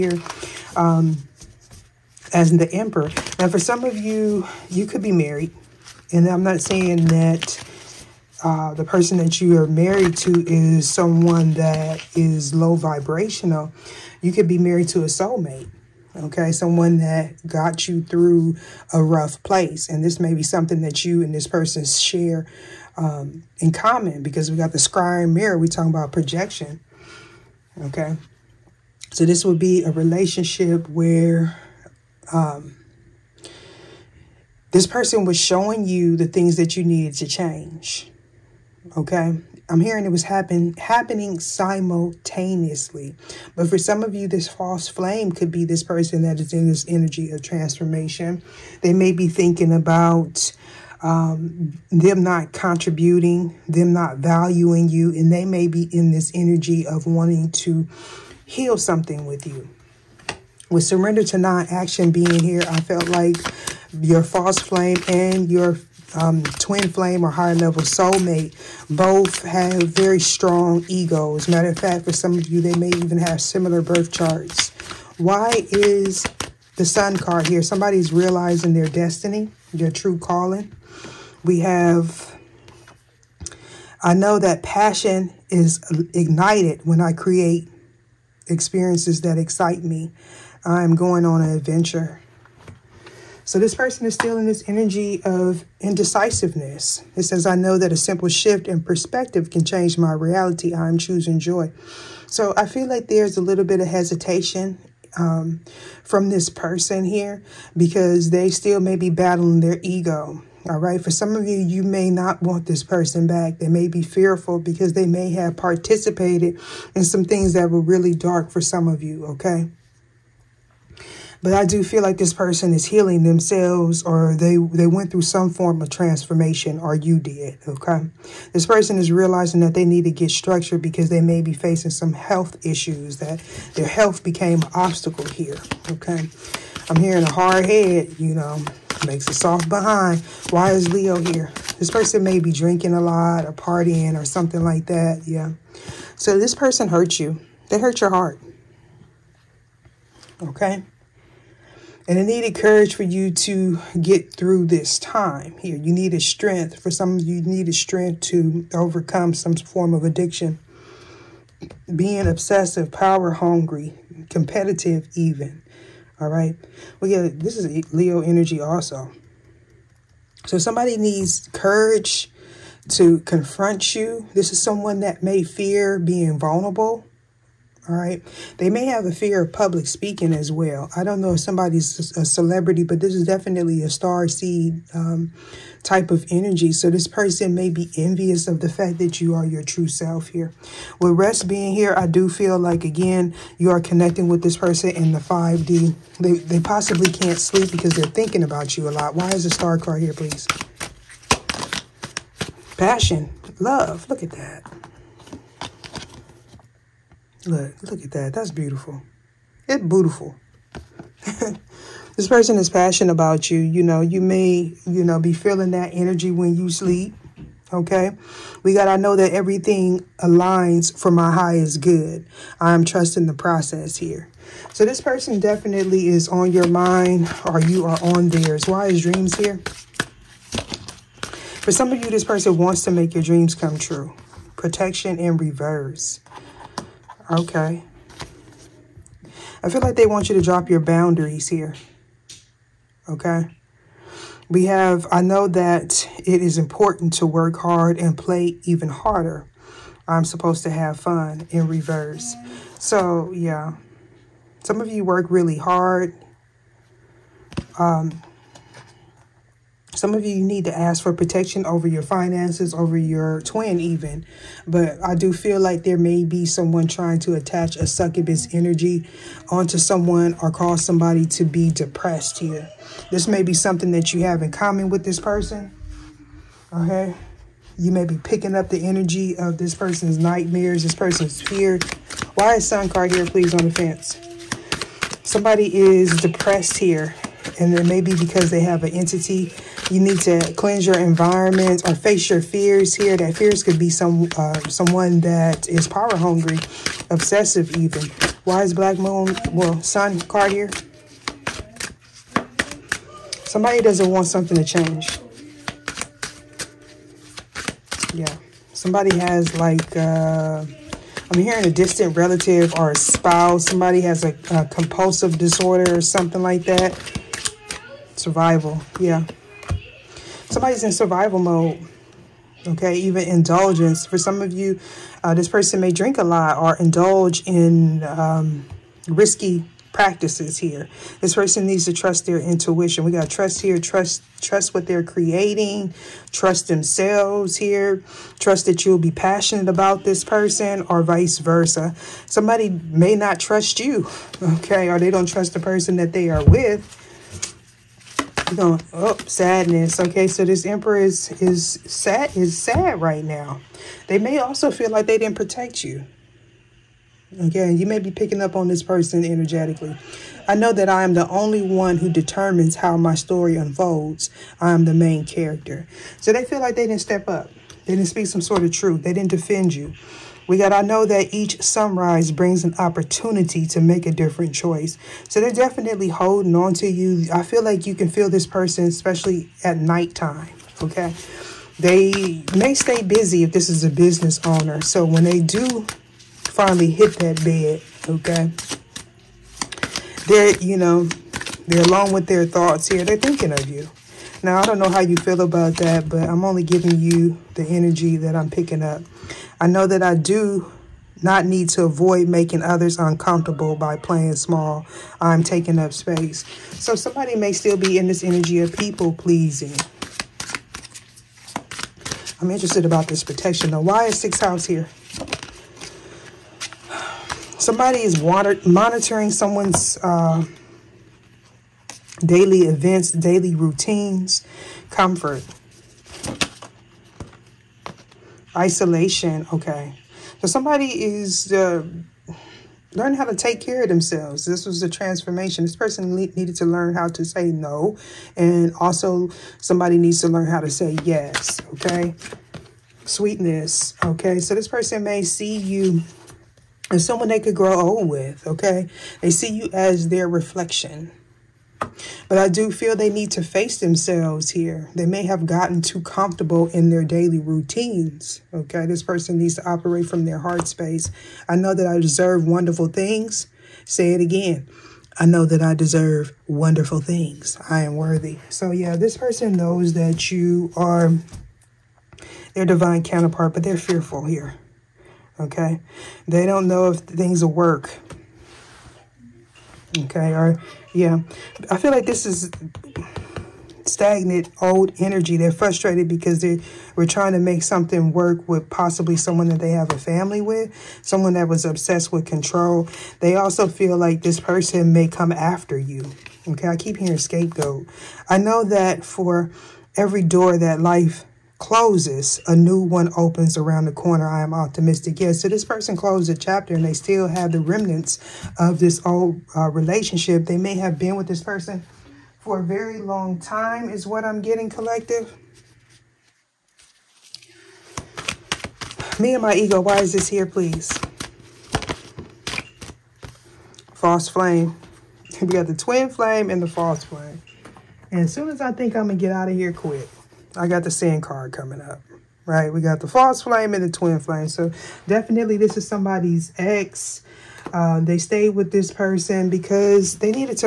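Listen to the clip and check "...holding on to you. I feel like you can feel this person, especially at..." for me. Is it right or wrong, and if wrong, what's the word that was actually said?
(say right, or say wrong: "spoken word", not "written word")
right.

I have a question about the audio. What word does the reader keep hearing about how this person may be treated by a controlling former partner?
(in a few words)
Scapegoat.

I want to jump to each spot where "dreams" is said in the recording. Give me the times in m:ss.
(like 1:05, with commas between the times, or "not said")
3:49, 3:53.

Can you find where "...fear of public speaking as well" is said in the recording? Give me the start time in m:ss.
2:59.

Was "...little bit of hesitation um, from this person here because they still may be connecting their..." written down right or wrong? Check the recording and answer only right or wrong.
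wrong.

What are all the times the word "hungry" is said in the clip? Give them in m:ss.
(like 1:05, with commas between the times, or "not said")
2:43, 4:56.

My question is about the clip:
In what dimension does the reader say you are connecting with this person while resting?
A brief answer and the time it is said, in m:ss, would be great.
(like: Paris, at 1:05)
5D, at 3:15.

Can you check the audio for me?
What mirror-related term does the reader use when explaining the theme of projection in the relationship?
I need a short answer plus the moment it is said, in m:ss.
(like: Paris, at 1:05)
Square mirror, at 0:24.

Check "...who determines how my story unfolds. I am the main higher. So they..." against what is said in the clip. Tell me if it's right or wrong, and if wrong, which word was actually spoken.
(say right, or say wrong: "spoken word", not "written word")
wrong: "character", not "higher".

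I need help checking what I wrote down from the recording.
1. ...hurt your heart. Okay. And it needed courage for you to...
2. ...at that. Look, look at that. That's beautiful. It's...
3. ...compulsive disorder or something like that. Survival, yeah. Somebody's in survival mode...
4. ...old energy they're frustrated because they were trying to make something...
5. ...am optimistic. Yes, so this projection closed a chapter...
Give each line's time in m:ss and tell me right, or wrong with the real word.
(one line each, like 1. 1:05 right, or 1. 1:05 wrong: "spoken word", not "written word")
1. 2:27 right
2. 3:24 right
3. 5:14 right
4. 8:04 right
5. 8:24 wrong: "person", not "projection".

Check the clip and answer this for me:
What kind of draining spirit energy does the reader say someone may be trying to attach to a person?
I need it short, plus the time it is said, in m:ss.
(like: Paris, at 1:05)
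Succubus, at 4:27.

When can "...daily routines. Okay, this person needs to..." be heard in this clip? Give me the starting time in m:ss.
7:37.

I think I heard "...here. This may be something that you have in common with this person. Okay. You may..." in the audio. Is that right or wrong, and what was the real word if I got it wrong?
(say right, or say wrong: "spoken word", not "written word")
right.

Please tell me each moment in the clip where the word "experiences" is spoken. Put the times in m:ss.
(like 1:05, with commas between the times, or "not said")
1:28.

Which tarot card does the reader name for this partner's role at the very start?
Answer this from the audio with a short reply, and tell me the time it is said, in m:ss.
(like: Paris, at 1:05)
The Emperor, at 0:02.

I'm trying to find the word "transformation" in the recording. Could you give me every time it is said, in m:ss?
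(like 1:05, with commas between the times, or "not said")
0:47, 2:05, 7:14.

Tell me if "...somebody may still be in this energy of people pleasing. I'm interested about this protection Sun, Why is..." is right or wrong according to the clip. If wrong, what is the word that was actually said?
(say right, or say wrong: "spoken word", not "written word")
wrong: "Now", not "Sun".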